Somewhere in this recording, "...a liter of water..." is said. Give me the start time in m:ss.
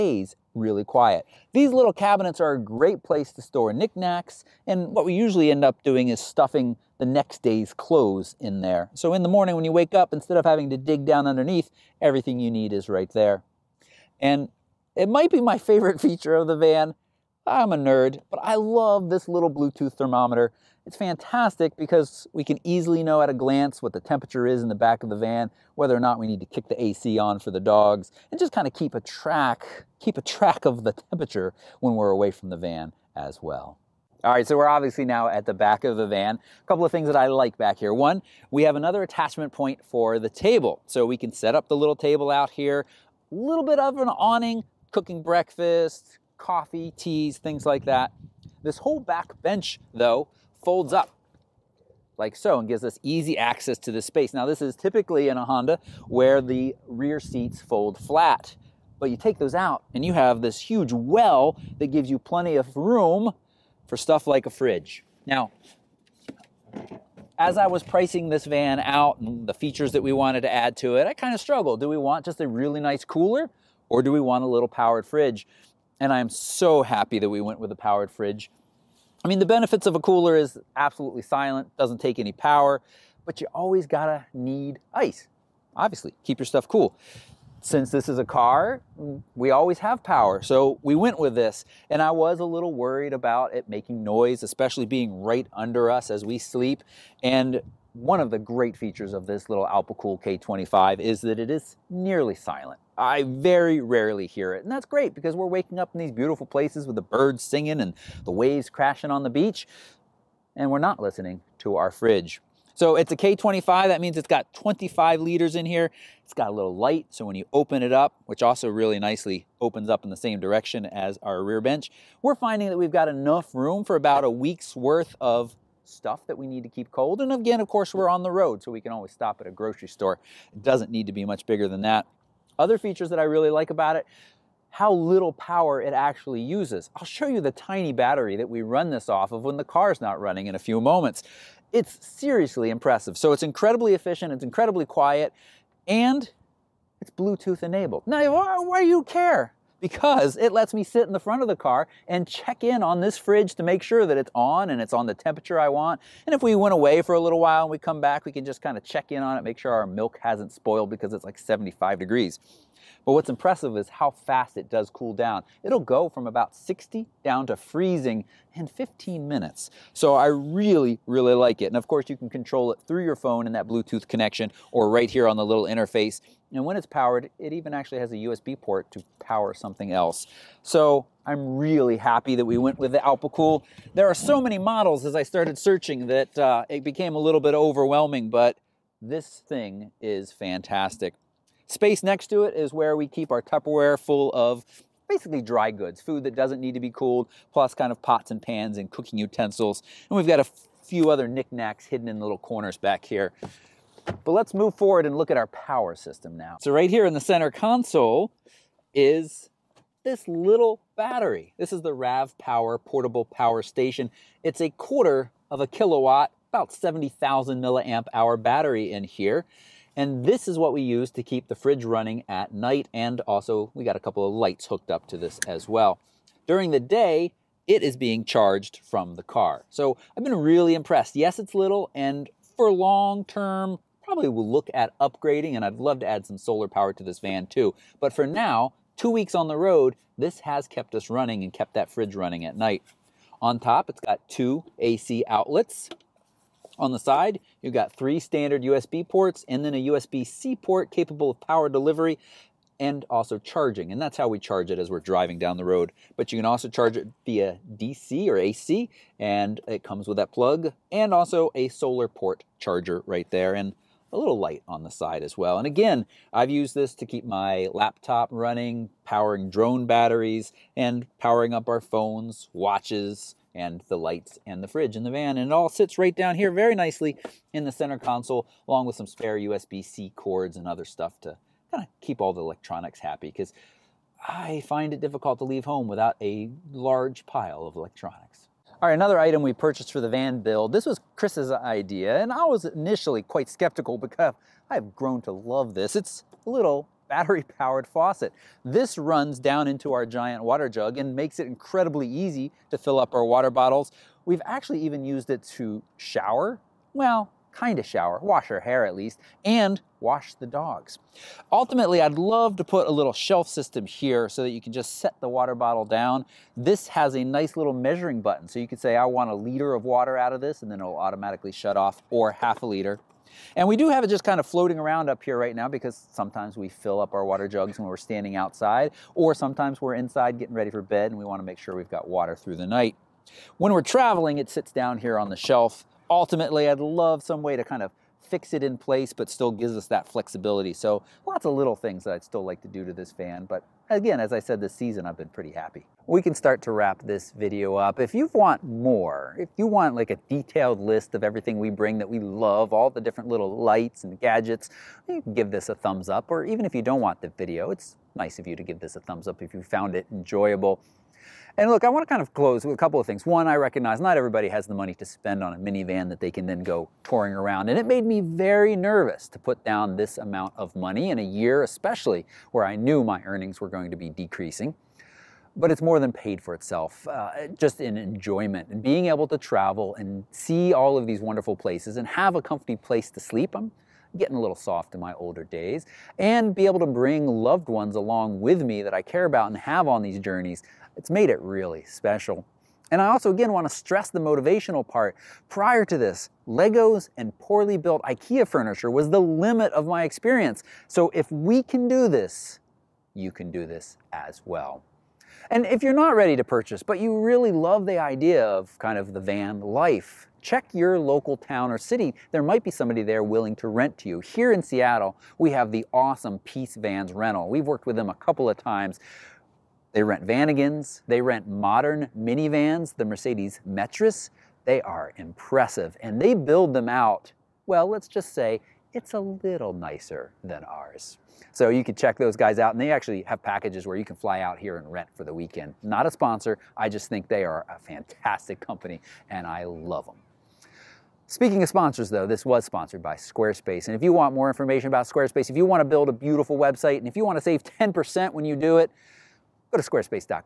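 5:19.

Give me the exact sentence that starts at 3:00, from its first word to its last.
So I'm really happy that we went with the Alpicool.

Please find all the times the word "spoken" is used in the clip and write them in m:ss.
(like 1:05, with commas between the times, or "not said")
not said.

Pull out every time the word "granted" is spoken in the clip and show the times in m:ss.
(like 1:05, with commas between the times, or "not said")
not said.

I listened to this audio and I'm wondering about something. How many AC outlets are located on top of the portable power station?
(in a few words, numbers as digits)
2.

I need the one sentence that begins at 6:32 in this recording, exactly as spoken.
And I also again want to stress the motivational part.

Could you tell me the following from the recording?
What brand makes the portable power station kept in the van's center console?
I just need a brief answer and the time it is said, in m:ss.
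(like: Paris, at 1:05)
RAV Power, at 3:31.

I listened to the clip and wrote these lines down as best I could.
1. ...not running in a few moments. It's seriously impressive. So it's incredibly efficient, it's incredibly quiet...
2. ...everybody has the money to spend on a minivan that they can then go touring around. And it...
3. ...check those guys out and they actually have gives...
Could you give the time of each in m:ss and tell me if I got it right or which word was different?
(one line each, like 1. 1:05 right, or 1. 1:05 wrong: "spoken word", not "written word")
1. 2:20 right
2. 6:04 right
3. 7:11 wrong: "packages", not "gives".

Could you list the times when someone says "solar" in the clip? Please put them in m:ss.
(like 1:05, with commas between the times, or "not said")
3:56, 4:21.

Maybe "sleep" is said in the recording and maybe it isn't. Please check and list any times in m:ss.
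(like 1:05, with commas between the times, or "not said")
1:36, 6:23.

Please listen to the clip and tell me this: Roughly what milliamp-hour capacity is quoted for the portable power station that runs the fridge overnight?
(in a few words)
70,000 milliamp hour.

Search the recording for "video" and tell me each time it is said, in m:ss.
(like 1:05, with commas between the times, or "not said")
5:47, 5:57.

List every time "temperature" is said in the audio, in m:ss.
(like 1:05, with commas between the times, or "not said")
0:24, 0:31, 2:35.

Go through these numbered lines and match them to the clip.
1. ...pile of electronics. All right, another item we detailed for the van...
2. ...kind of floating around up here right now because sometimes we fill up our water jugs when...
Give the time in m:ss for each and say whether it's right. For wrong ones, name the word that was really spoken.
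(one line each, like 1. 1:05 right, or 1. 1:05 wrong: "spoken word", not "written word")
1. 4:47 wrong: "purchased", not "detailed"
2. 5:24 right.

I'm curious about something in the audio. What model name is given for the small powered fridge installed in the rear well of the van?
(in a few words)
Alpicool K25.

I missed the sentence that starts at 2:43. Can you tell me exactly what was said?
But what's impressive is how fast it does cool down.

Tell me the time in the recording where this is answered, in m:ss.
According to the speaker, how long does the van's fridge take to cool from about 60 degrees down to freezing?
2:48.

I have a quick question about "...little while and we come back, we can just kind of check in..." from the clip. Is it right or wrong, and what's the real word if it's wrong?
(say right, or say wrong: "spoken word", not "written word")
right.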